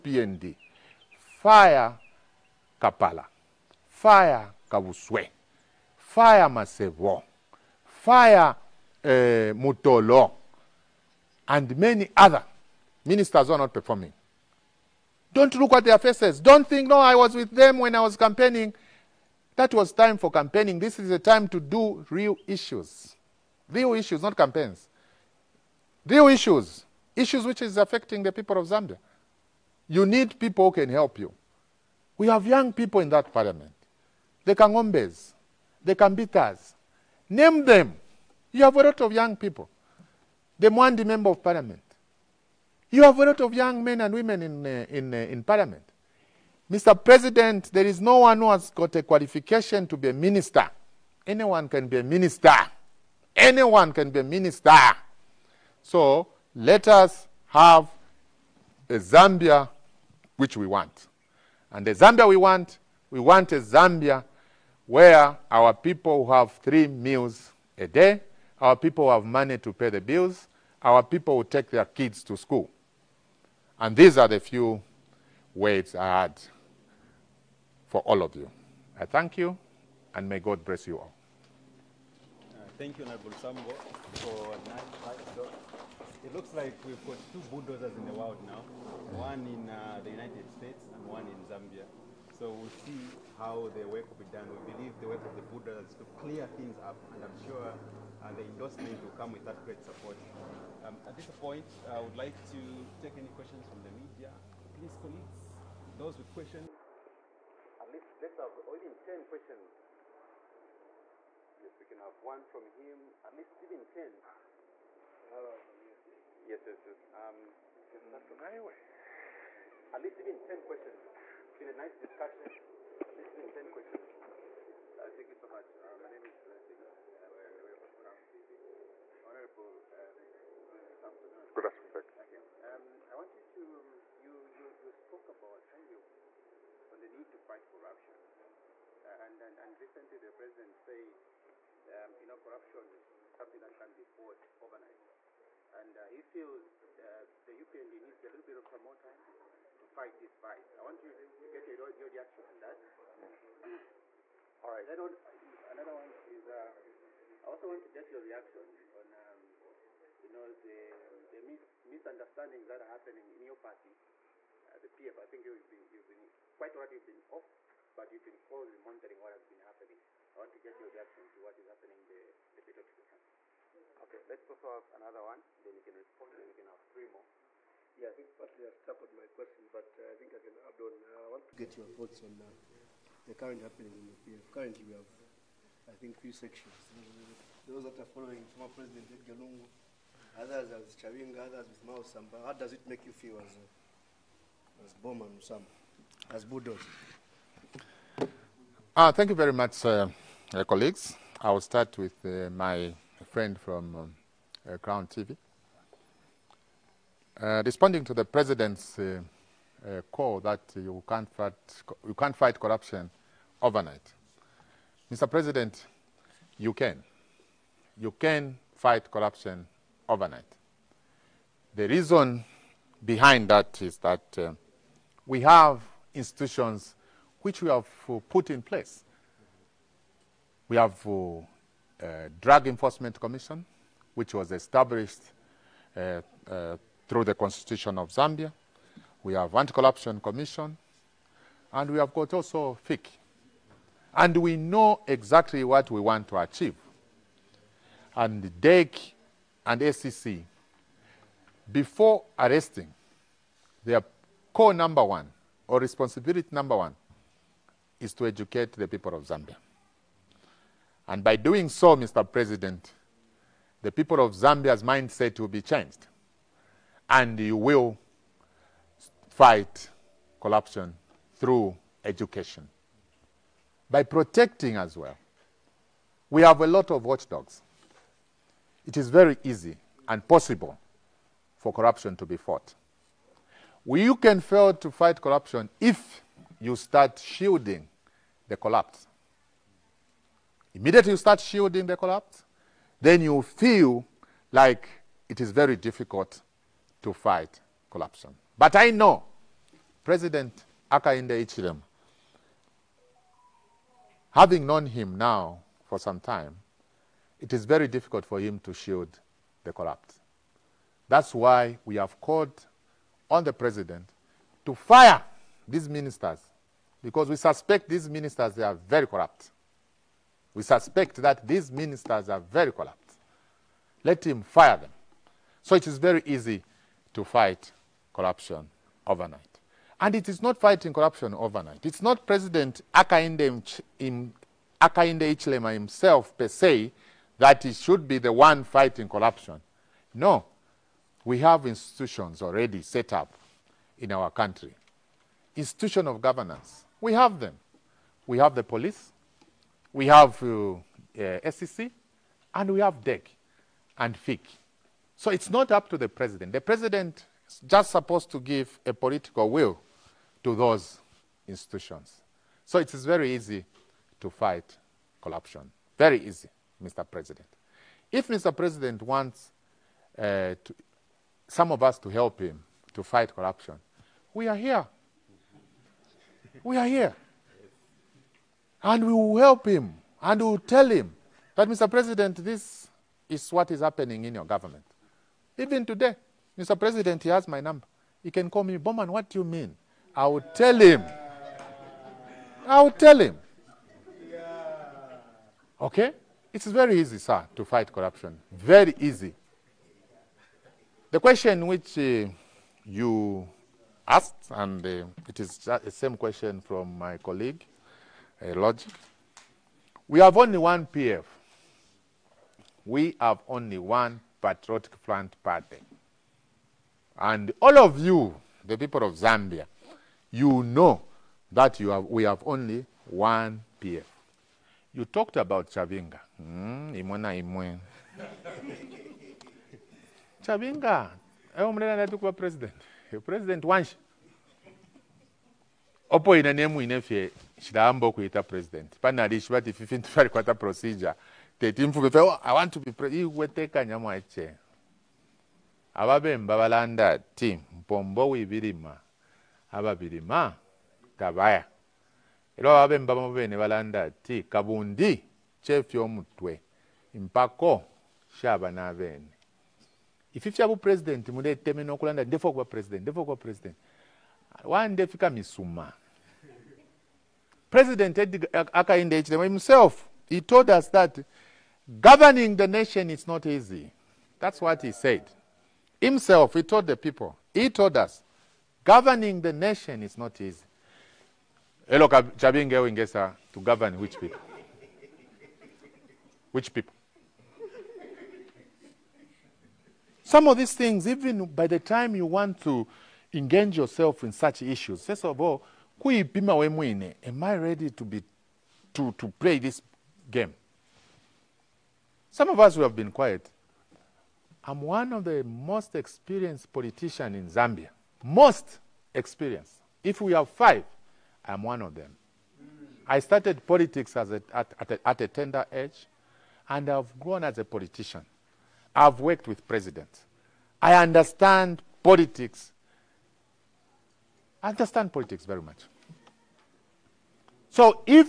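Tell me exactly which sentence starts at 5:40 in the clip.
No, we have institutions already set up in our country.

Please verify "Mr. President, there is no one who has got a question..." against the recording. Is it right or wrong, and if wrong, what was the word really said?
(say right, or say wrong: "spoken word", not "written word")
wrong: "qualification", not "question".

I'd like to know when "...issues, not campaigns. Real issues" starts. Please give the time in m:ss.
0:23.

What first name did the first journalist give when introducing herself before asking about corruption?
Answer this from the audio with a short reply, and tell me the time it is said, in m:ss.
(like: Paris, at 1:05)
Blessings, at 2:06.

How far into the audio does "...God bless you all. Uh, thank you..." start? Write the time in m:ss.
1:20.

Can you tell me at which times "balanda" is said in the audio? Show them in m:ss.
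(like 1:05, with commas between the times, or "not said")
7:26, 7:33.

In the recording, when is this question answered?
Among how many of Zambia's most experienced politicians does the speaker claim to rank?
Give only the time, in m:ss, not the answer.
8:30.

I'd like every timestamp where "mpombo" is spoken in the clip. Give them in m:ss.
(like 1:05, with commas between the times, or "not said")
7:27.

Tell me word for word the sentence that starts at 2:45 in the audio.
I think you've been you've been quite right.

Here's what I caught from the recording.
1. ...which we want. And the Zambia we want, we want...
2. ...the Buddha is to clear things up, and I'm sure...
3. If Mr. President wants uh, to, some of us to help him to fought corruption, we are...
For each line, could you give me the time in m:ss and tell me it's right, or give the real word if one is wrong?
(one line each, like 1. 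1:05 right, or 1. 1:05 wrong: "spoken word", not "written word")
1. 1:00 right
2. 1:35 right
3. 6:08 wrong: "fight", not "fought".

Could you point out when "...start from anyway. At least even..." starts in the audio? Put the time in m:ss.
1:58.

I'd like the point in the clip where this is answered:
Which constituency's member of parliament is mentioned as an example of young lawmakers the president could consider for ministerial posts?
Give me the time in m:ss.
0:40.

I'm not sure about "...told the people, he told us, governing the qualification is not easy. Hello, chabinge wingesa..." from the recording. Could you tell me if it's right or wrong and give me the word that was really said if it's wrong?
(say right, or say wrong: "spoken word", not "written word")
wrong: "nation", not "qualification".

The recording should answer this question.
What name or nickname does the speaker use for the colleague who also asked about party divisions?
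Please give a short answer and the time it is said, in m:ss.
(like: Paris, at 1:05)
Logic, at 6:48.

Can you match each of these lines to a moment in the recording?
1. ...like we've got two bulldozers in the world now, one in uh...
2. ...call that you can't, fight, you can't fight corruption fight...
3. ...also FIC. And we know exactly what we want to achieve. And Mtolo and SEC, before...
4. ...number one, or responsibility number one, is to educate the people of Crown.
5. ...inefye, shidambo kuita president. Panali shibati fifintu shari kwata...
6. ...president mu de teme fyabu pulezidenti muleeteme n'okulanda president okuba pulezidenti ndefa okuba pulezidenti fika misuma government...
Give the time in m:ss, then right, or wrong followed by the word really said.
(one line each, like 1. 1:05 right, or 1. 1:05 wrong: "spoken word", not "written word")
1. 1:26 right
2. 3:30 wrong: "overnight", not "fight"
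3. 4:02 wrong: "DEC", not "Mtolo"
4. 4:14 wrong: "Zambia", not "Crown"
5. 7:16 right
6. 7:40 wrong: "president", not "government".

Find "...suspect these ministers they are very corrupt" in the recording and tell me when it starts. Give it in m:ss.
5:17.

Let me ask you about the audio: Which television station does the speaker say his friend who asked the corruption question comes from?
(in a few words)
Crown TV.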